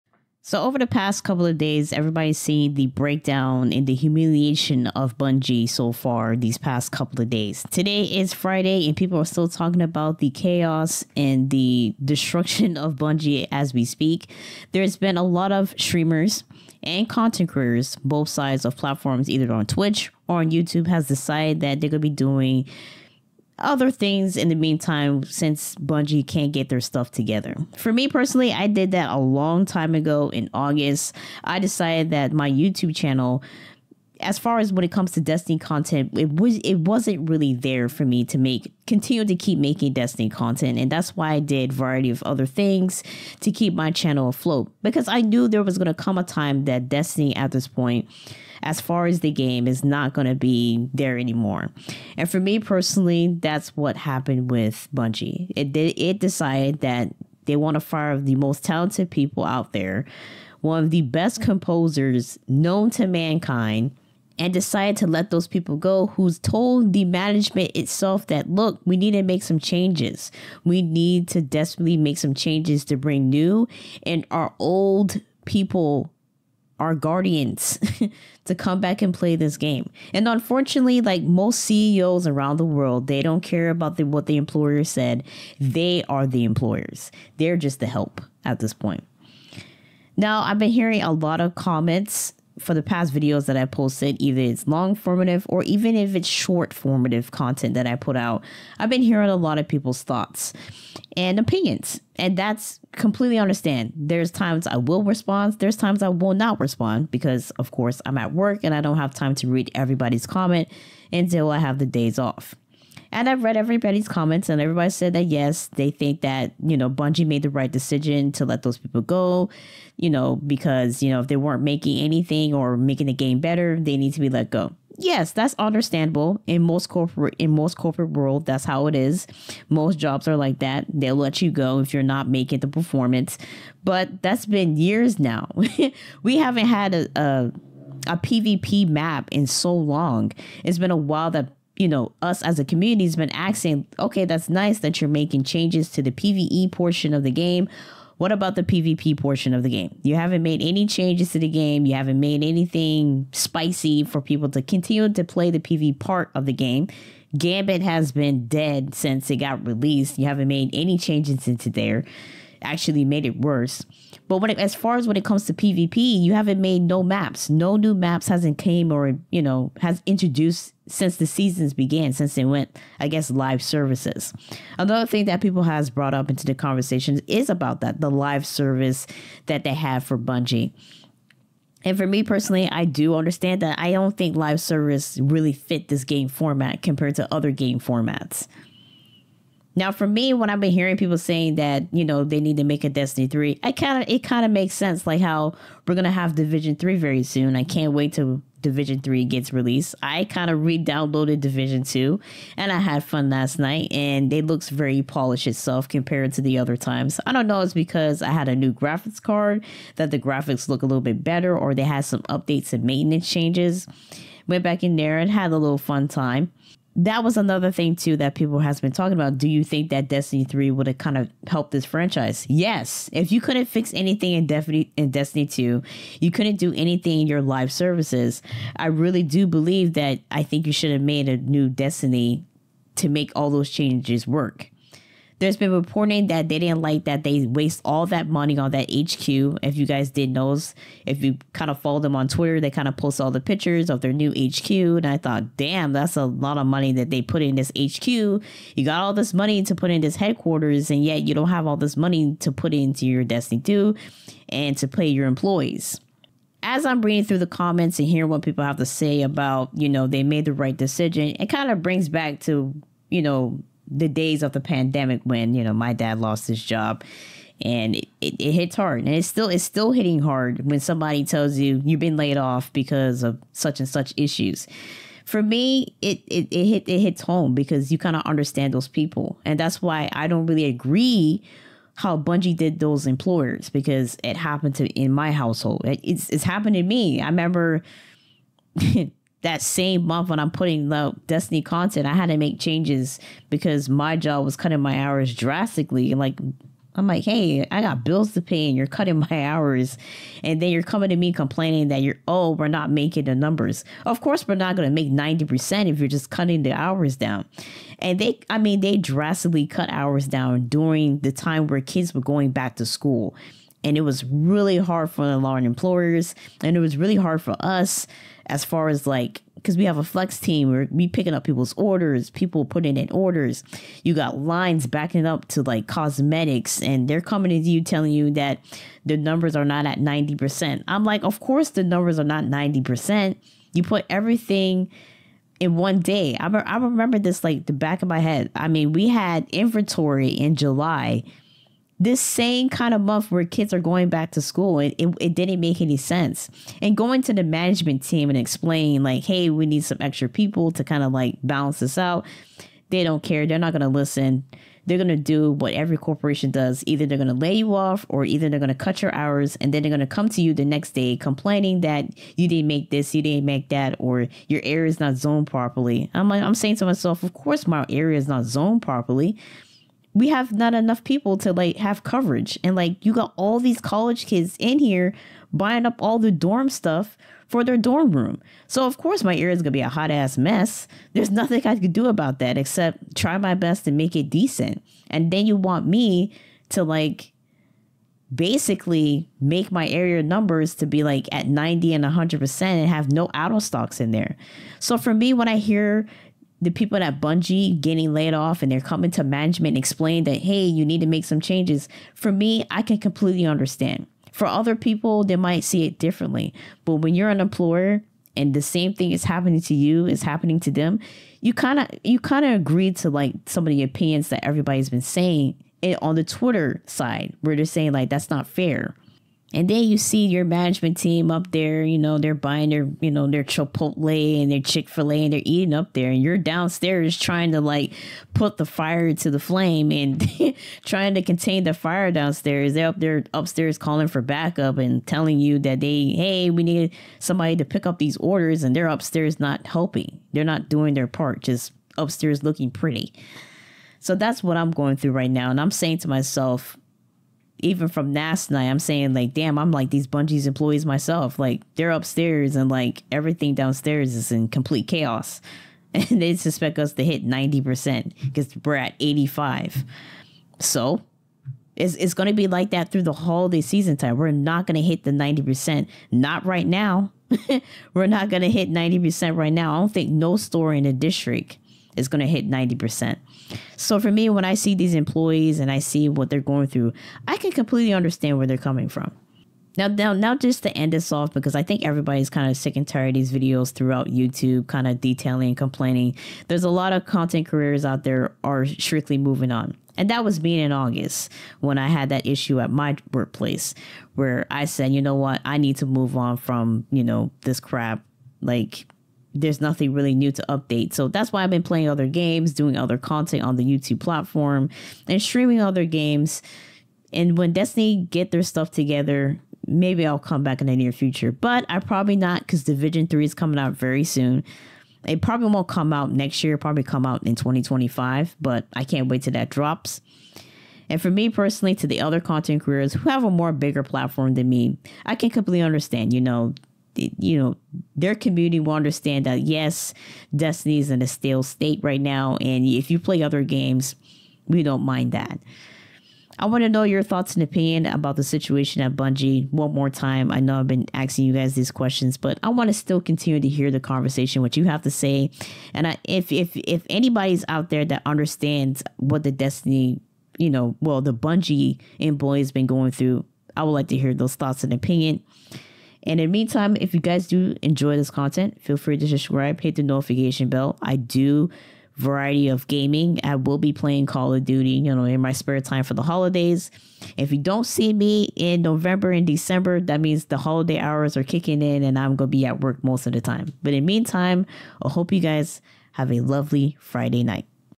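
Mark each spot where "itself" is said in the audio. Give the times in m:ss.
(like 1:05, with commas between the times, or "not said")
1:07, 3:25.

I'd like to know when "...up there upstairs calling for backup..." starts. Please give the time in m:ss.
7:12.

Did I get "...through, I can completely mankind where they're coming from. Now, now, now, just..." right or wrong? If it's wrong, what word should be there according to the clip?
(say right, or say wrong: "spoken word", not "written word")
wrong: "understand", not "mankind".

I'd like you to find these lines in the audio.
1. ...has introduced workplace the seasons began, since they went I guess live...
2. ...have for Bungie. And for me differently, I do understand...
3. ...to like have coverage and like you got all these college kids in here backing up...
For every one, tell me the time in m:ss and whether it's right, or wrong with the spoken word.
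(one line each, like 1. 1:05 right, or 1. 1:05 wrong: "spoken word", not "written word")
1. 2:49 wrong: "since", not "workplace"
2. 2:59 wrong: "personally", not "differently"
3. 6:11 wrong: "buying", not "backing".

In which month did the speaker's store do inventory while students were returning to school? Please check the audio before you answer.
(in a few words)
July.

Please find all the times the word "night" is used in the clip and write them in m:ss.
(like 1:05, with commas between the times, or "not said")
3:23, 7:28, 9:37.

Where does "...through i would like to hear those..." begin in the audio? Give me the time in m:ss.
9:12.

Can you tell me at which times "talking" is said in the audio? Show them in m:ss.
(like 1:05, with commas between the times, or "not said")
0:09, 3:38.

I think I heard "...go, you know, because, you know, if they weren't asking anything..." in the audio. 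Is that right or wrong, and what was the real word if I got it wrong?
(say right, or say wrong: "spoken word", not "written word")
wrong: "making", not "asking".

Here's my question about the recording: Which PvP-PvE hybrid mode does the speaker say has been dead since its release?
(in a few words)
Gambit.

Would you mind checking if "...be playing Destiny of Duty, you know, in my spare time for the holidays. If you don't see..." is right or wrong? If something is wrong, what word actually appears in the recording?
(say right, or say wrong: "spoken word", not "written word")
wrong: "Call", not "Destiny".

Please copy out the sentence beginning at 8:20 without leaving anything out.
So that's why I've been playing other games, doing other content on the YouTube platform, and streaming other games.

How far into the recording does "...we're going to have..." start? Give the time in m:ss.
3:15.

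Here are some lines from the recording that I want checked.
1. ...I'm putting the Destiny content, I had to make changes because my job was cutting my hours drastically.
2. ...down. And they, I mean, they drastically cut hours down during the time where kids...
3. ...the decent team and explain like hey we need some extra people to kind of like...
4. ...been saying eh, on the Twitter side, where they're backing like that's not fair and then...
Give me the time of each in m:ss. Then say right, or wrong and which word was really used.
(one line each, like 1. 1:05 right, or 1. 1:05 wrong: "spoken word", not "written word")
1. 4:50 right
2. 5:07 right
3. 5:47 wrong: "management", not "decent"
4. 6:54 wrong: "saying", not "backing".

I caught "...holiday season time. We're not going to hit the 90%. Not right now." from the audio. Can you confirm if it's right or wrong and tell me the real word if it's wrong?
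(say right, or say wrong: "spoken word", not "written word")
right.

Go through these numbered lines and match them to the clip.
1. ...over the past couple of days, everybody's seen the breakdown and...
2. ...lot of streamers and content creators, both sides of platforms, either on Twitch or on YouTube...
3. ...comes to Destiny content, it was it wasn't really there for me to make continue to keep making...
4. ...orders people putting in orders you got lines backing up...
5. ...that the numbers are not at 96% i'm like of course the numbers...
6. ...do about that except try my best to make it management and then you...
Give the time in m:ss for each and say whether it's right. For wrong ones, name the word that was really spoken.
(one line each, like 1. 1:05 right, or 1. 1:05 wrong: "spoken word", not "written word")
1. 0:00 right
2. 0:15 right
3. 0:34 right
4. 5:21 right
5. 5:28 wrong: "90", not "96"
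6. 6:21 wrong: "decent", not "management".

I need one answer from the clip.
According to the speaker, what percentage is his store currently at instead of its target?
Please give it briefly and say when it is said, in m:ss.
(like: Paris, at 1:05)
85, at 7:39.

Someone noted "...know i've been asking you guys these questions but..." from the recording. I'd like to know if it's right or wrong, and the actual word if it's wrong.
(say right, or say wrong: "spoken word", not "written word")
right.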